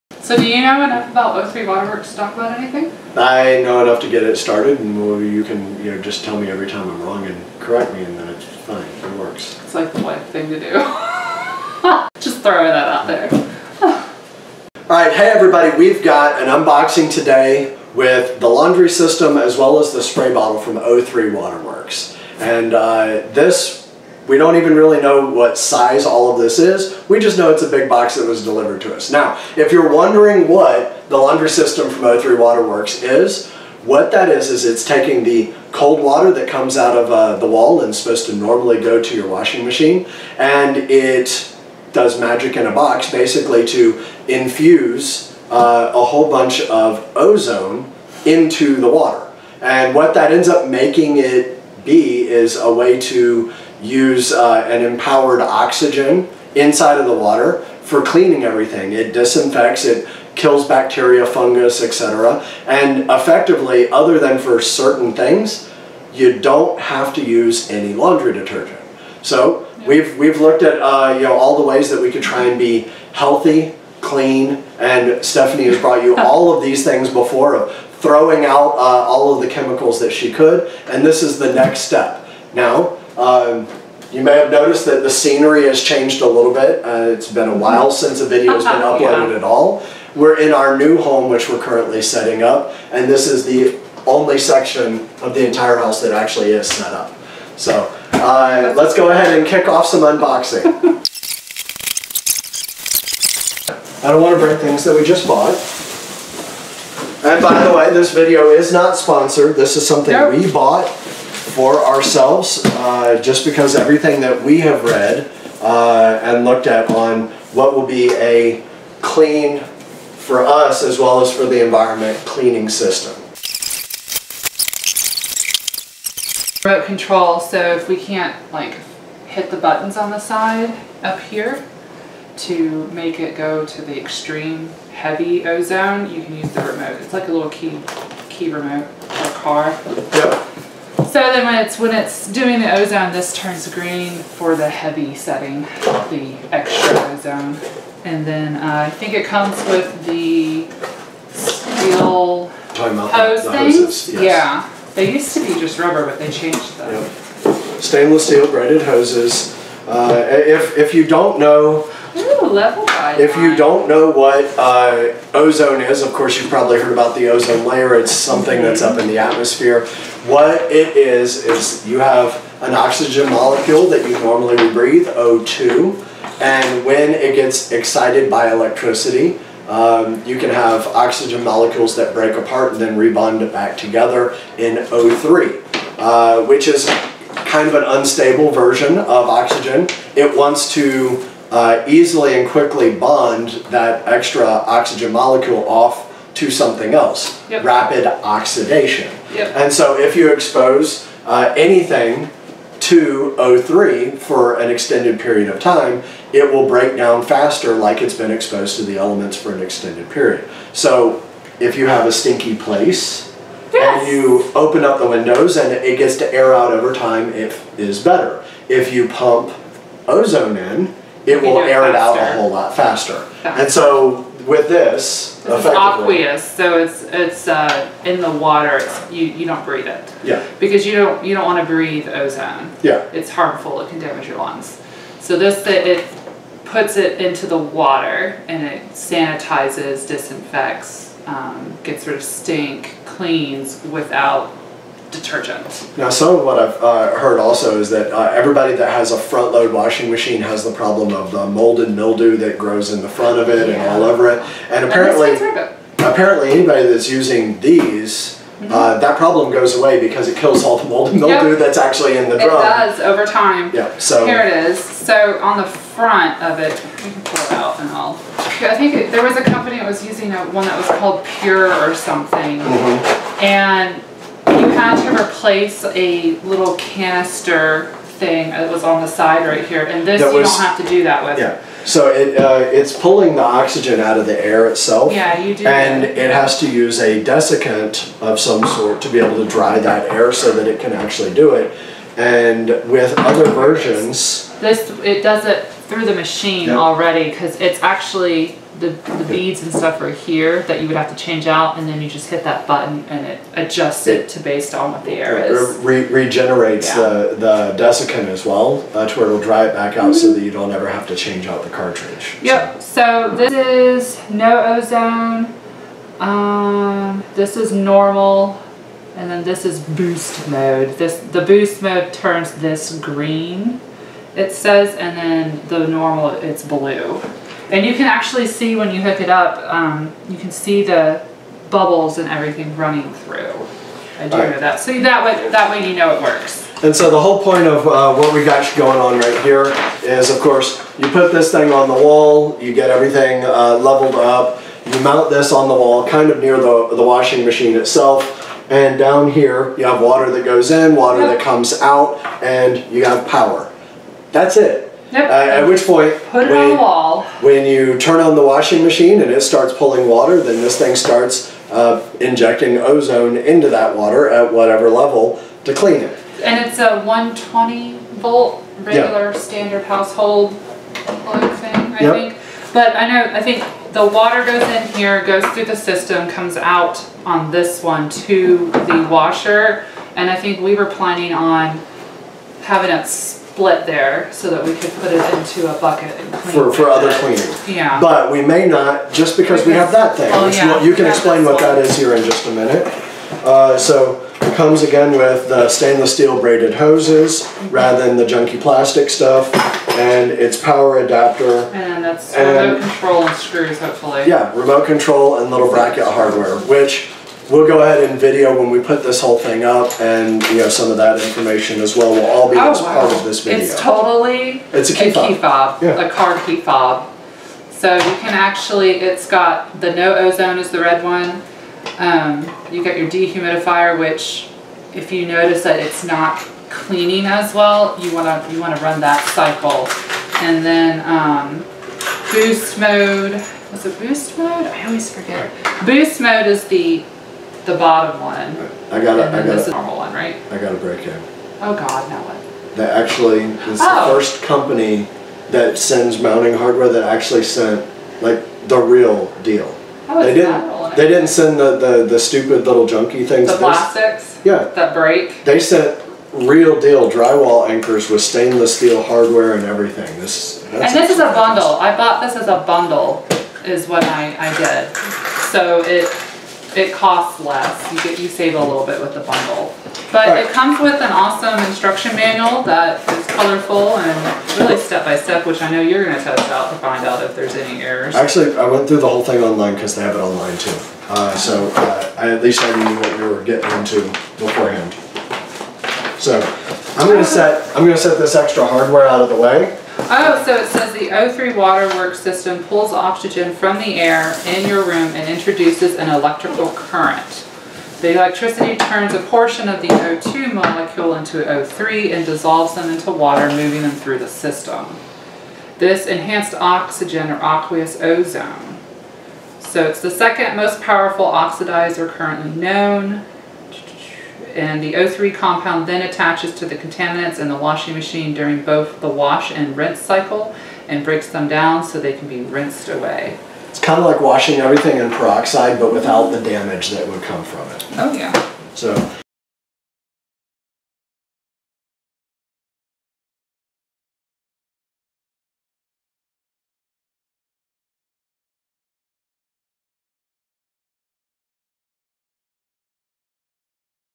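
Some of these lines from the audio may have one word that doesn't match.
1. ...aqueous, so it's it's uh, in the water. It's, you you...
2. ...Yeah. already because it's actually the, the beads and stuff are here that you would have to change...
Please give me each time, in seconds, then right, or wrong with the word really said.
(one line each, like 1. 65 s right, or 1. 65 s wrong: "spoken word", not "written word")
1. 225 s right
2. 296 s right.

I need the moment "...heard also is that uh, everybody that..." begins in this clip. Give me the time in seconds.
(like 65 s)
247 s.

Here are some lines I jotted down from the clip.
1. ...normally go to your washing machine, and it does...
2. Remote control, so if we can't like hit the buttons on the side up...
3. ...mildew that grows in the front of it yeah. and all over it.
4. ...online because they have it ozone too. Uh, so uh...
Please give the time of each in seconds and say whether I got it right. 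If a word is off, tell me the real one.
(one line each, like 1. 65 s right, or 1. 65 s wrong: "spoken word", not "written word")
1. 38 s right
2. 126 s right
3. 251 s right
4. 479 s wrong: "online", not "ozone".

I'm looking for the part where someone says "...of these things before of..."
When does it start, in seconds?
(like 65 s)
76 s.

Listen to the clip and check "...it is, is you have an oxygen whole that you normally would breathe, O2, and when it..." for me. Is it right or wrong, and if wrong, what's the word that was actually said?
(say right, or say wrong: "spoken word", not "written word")
wrong: "molecule", not "whole".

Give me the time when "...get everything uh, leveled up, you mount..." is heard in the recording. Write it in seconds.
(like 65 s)
342 s.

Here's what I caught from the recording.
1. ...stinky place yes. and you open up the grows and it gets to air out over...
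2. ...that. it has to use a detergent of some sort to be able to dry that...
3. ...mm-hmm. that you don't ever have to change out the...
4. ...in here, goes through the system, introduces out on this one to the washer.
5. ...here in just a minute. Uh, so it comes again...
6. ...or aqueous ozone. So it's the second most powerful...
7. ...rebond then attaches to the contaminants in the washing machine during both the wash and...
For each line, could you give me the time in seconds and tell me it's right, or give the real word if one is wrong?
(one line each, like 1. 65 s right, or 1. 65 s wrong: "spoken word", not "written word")
1. 212 s wrong: "windows", not "grows"
2. 286 s wrong: "desiccant", not "detergent"
3. 310 s right
4. 374 s wrong: "comes", not "introduces"
5. 391 s right
6. 507 s right
7. 515 s wrong: "compound", not "rebond".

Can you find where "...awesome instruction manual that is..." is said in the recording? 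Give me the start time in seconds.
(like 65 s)
471 s.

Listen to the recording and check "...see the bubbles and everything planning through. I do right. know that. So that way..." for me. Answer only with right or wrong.
wrong.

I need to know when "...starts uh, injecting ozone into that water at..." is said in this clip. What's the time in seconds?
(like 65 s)
360 s.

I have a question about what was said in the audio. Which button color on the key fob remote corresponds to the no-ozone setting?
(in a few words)
Red.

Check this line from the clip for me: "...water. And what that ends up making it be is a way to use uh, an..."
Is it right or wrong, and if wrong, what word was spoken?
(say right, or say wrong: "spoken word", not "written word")
right.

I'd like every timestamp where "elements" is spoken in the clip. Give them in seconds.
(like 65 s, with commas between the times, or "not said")
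208 s.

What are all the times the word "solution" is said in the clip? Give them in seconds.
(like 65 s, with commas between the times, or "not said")
not said.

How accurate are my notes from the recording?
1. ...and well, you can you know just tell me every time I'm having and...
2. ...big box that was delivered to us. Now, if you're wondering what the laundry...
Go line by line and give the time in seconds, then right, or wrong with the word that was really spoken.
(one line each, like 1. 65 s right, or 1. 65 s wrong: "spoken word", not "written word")
1. 4 s wrong: "wrong", not "having"
2. 27 s right.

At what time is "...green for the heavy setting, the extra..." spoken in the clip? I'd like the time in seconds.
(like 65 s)
143 s.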